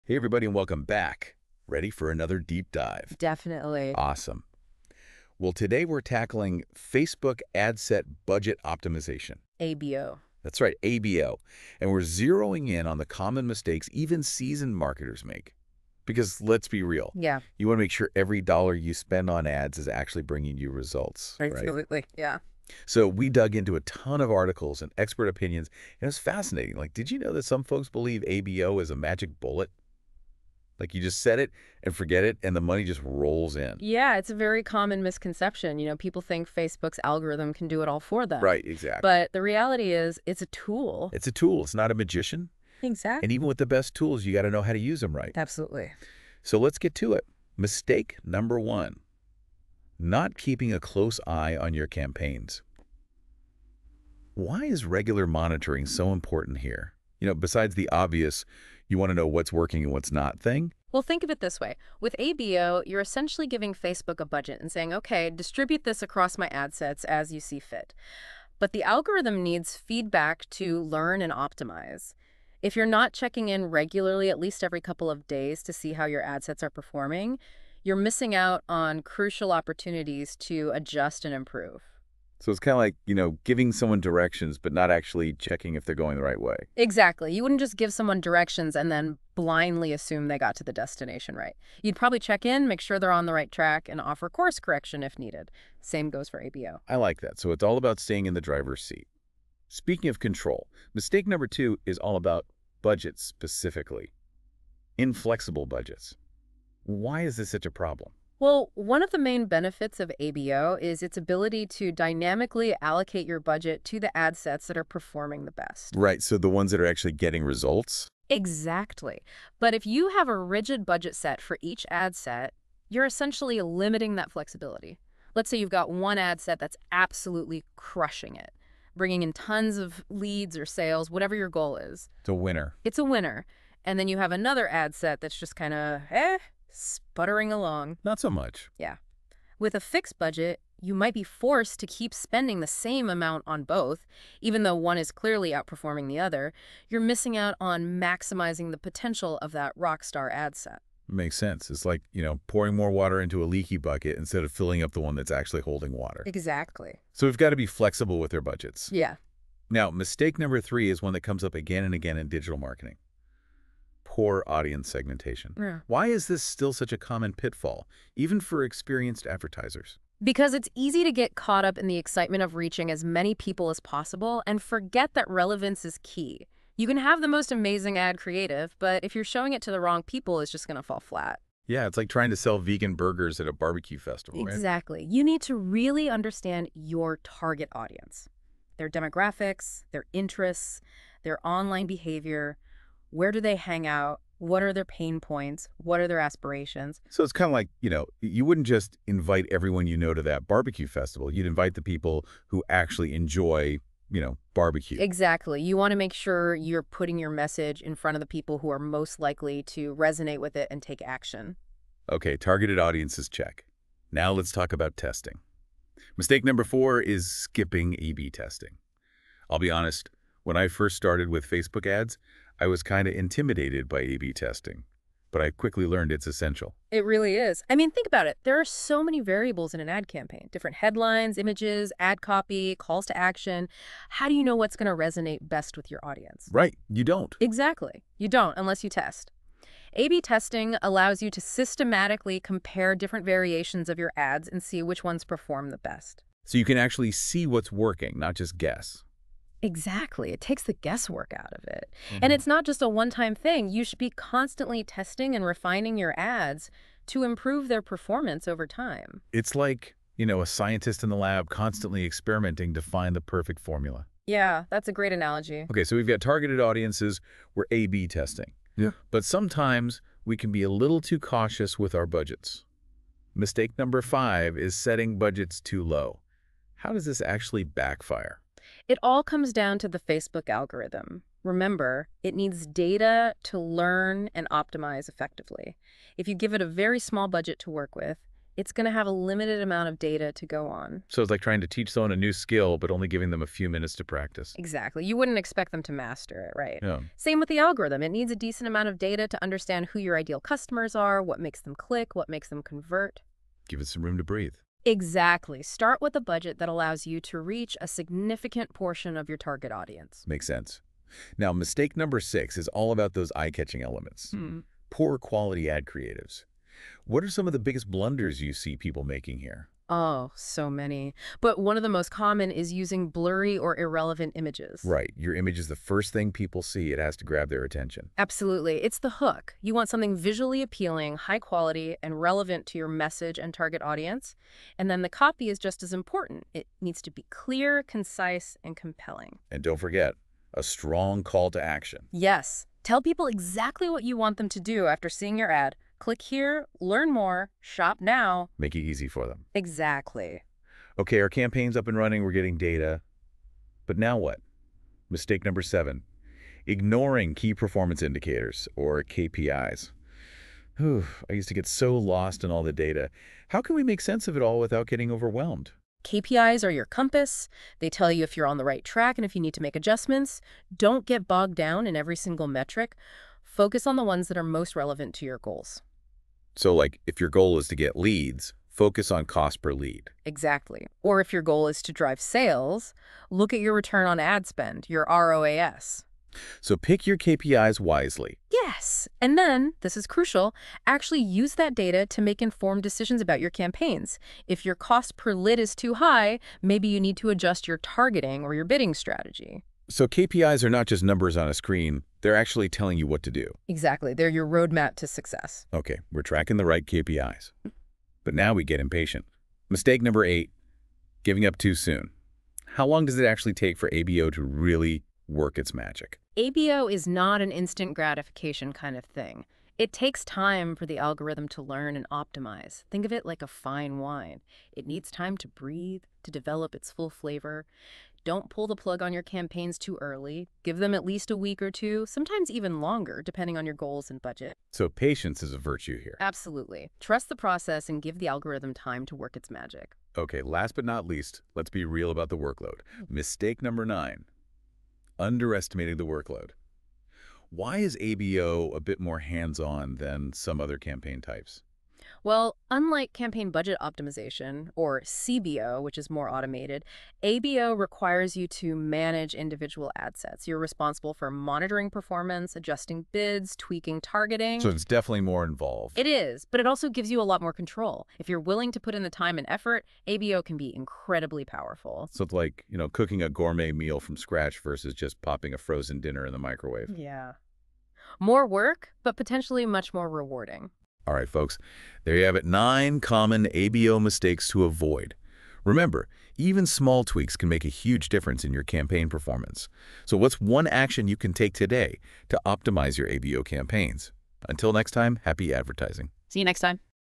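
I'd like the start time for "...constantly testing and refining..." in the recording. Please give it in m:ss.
4:14.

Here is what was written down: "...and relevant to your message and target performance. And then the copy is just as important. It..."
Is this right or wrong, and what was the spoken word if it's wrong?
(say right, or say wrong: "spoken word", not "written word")
wrong: "audience", not "performance".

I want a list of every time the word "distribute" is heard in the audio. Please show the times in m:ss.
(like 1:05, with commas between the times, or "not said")
1:05.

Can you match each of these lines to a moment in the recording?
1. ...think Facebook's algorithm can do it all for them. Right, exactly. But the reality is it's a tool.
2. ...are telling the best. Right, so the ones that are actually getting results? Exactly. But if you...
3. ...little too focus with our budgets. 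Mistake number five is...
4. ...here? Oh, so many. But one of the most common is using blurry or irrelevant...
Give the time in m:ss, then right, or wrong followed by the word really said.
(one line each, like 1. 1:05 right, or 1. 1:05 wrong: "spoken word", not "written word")
1. 0:36 right
2. 1:54 wrong: "performing", not "telling"
3. 4:30 wrong: "cautious", not "focus"
4. 5:19 right.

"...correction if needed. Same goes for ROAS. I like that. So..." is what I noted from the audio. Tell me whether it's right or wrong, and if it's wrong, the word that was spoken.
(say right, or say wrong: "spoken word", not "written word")
wrong: "ABO", not "ROAS".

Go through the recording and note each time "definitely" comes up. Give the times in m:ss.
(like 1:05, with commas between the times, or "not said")
0:03, 7:44.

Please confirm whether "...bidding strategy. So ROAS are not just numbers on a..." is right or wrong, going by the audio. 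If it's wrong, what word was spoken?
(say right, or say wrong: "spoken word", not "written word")
wrong: "KPIs", not "ROAS".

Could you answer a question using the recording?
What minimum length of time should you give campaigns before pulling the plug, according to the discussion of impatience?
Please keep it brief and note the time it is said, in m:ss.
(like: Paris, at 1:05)
A week or two, at 7:11.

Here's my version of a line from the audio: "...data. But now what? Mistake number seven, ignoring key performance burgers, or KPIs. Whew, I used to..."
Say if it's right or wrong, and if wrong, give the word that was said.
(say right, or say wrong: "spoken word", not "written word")
wrong: "indicators", not "burgers".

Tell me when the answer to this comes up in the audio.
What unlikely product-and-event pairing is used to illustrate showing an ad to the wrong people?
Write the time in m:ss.
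3:02.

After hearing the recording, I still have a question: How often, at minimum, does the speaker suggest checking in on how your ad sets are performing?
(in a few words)
Every couple of days.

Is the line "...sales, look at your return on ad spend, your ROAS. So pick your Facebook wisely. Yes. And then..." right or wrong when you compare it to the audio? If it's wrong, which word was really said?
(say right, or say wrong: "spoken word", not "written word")
wrong: "KPIs", not "Facebook".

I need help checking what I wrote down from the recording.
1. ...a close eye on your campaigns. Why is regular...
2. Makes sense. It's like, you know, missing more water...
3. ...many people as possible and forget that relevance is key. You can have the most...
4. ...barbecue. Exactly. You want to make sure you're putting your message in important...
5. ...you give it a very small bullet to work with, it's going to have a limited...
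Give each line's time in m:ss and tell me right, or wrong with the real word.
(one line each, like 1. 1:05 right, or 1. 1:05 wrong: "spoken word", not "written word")
1. 0:50 right
2. 2:31 wrong: "pouring", not "missing"
3. 2:53 right
4. 3:24 wrong: "front", not "important"
5. 4:46 wrong: "budget", not "bullet".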